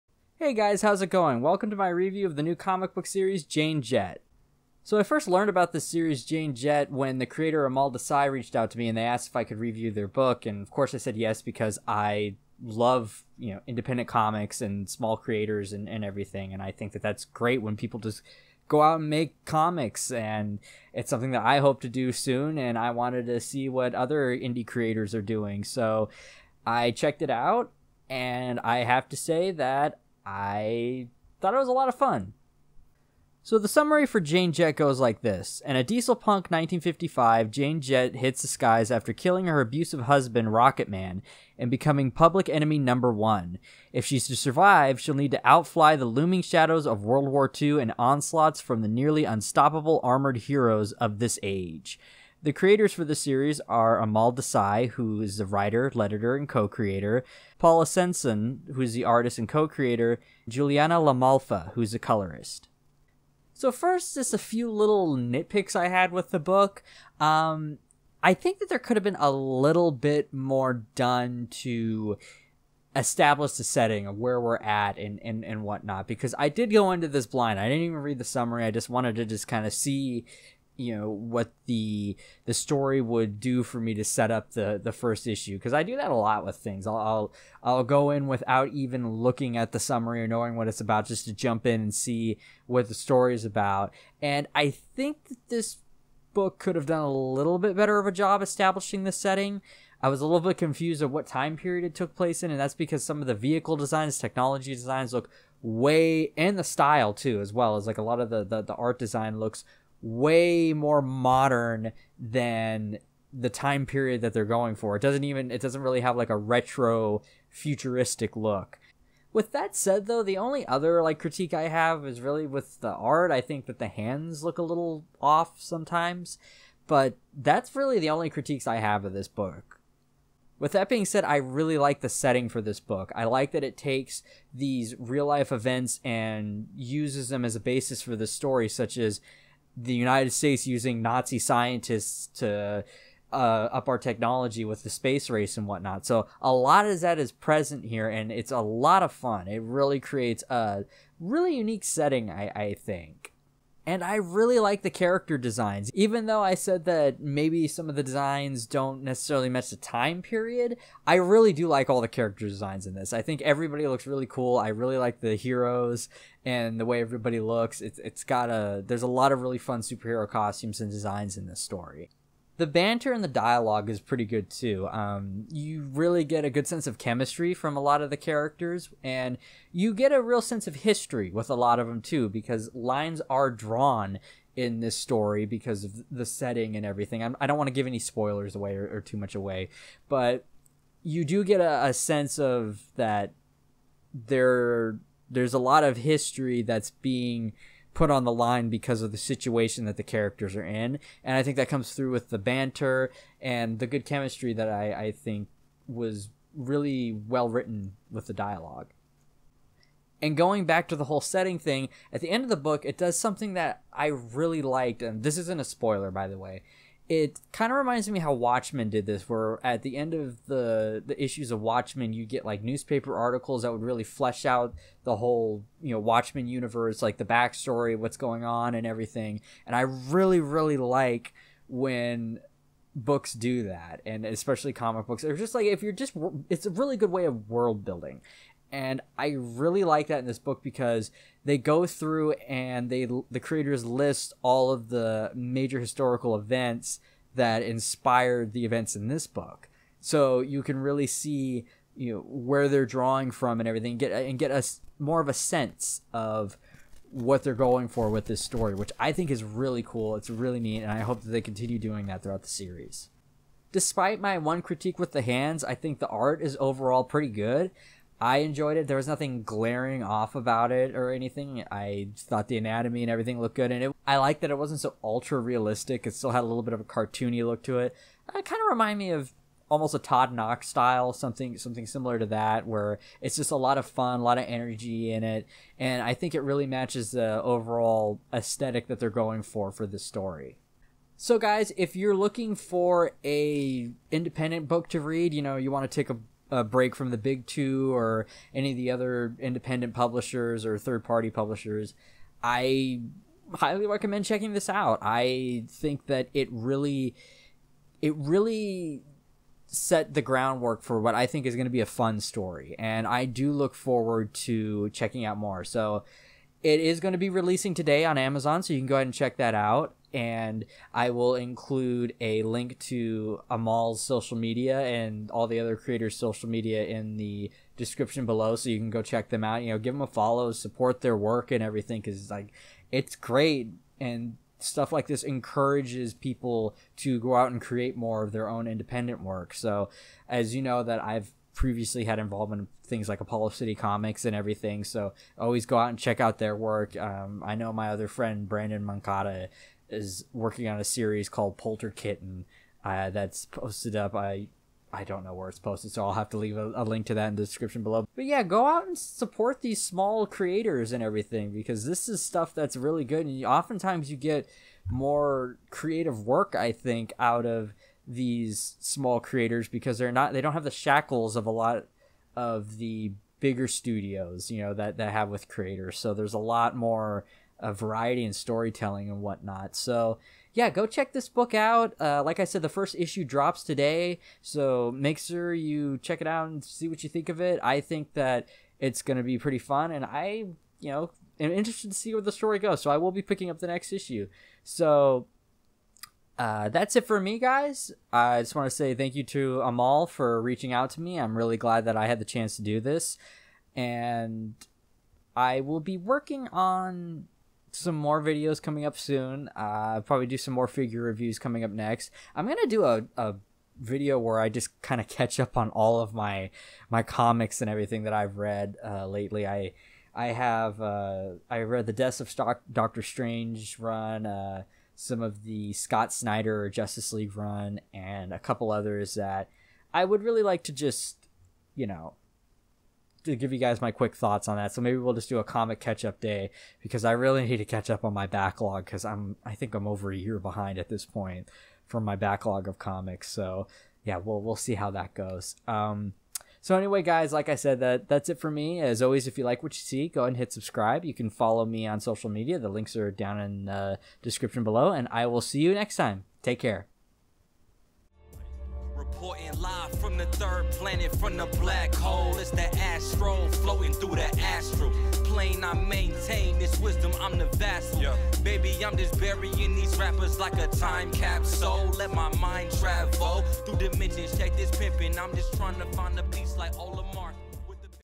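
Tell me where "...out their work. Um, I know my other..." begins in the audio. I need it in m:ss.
5:46.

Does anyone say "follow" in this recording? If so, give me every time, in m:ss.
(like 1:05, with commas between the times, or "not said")
5:30, 7:31.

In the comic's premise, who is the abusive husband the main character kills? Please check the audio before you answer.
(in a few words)
Rocket Man.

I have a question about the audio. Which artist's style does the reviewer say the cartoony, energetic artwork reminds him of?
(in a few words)
Todd Nauck.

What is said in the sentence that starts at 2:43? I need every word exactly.
I think everybody looks really cool.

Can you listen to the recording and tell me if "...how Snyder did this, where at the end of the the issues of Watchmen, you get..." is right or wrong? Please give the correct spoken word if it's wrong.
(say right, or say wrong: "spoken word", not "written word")
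wrong: "Watchmen", not "Snyder".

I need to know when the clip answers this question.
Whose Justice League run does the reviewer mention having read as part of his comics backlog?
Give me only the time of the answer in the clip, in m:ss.
7:05.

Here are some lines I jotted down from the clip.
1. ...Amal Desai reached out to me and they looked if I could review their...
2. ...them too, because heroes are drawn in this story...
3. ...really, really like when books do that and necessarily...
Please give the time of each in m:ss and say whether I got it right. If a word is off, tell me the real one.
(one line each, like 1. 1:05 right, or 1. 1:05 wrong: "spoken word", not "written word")
1. 0:07 wrong: "asked", not "looked"
2. 3:01 wrong: "lines", not "heroes"
3. 3:49 wrong: "especially", not "necessarily".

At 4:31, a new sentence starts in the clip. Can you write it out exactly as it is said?
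I thought the anatomy and everything looked good, and it, I like that it wasn't so ultra realistic.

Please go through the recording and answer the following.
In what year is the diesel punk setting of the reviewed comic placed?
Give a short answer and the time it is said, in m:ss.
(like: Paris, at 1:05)
1955, at 0:36.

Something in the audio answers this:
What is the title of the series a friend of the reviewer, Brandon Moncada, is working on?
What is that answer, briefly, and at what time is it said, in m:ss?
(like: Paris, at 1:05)
Polter Kitten, at 5:51.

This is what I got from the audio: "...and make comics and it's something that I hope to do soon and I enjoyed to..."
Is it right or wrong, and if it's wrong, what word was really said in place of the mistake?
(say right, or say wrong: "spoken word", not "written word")
wrong: "wanted", not "enjoyed".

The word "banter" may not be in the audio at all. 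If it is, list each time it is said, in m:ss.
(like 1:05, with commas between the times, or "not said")
2:52, 3:22.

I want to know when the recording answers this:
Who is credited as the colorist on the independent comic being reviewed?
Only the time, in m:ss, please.
1:00.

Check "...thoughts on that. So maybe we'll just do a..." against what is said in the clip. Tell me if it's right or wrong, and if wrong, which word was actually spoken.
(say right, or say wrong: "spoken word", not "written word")
right.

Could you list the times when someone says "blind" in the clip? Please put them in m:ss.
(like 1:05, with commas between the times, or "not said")
1:17.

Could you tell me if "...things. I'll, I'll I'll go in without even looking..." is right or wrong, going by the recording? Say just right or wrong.
right.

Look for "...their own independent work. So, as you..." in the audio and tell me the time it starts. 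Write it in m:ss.
5:38.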